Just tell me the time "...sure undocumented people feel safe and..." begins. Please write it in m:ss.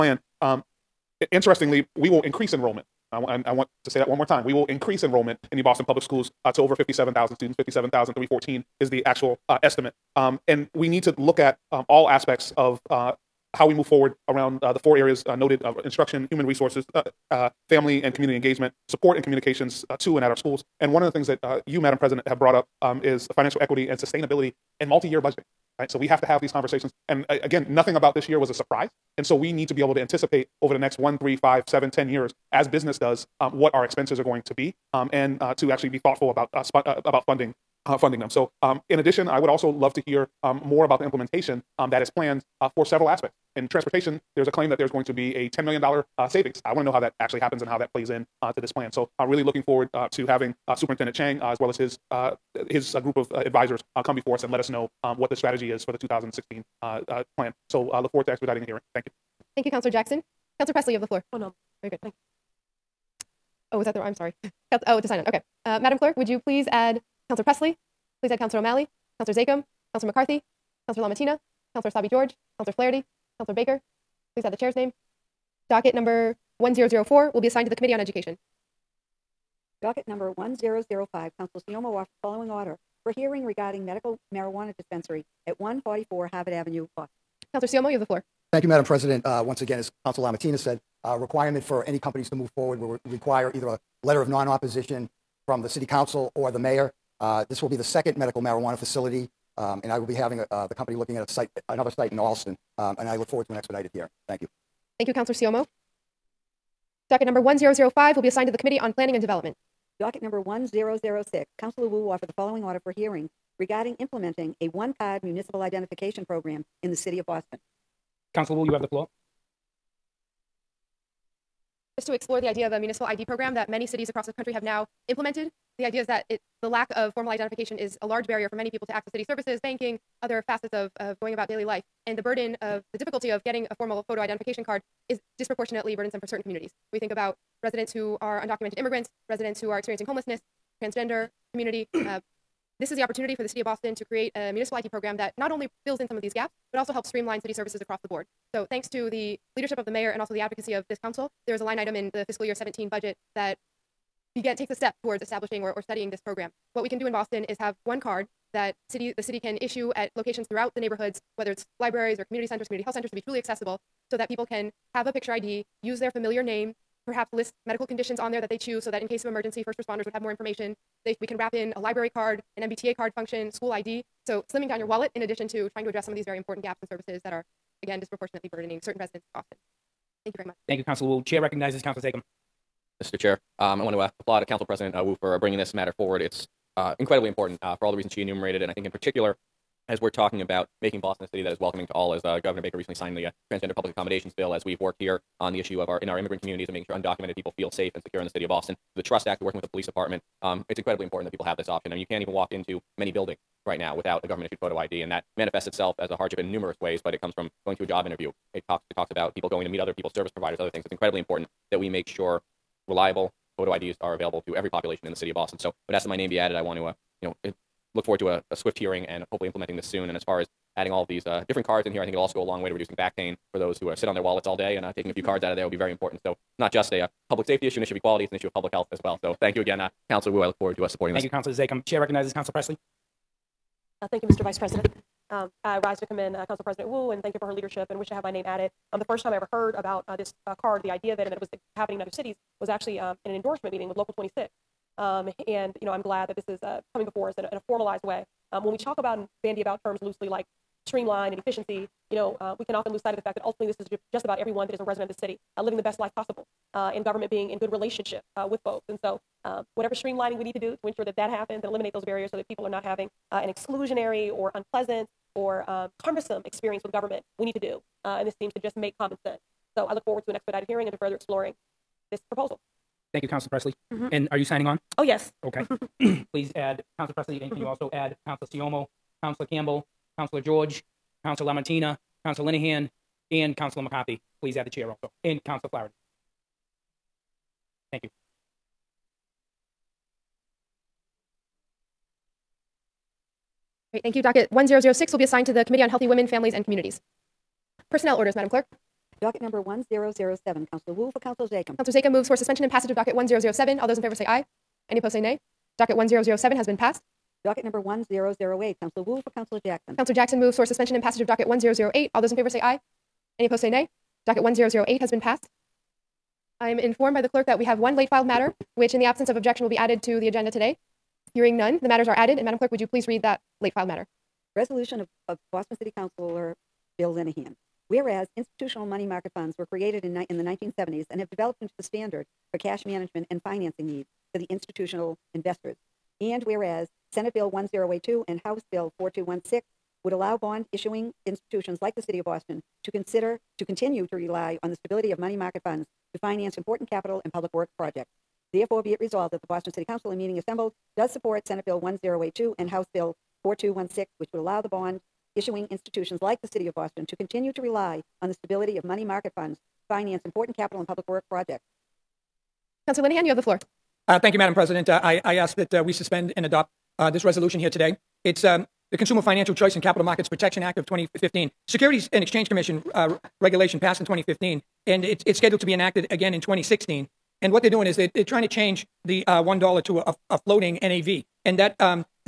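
3:16.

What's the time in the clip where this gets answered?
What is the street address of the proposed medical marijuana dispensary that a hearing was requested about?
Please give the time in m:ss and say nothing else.
1:25.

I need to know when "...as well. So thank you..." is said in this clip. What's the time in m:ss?
3:48.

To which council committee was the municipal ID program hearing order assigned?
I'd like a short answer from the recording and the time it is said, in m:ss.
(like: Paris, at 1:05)
Healthy Women, Families, and Communities, at 4:55.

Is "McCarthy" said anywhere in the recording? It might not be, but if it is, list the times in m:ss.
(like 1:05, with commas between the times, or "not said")
1:10, 4:43.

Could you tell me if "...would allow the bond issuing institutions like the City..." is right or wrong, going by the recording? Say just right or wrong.
right.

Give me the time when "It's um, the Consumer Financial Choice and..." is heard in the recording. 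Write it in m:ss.
6:08.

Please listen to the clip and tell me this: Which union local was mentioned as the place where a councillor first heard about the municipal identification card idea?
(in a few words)
Local 26.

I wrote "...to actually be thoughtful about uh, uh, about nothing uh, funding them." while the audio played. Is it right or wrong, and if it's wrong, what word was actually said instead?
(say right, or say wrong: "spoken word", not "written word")
wrong: "funding", not "nothing".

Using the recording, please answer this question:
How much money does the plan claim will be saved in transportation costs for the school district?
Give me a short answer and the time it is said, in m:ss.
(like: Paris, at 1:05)
$10 million, at 0:45.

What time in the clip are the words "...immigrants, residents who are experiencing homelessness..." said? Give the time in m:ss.
2:18.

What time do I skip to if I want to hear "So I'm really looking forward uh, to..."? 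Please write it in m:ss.
0:48.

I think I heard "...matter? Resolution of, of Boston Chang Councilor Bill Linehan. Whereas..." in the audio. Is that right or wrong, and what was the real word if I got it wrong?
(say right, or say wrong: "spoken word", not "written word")
wrong: "City", not "Chang".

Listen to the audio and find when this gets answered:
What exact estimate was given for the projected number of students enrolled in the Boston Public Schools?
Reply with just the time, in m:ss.
0:07.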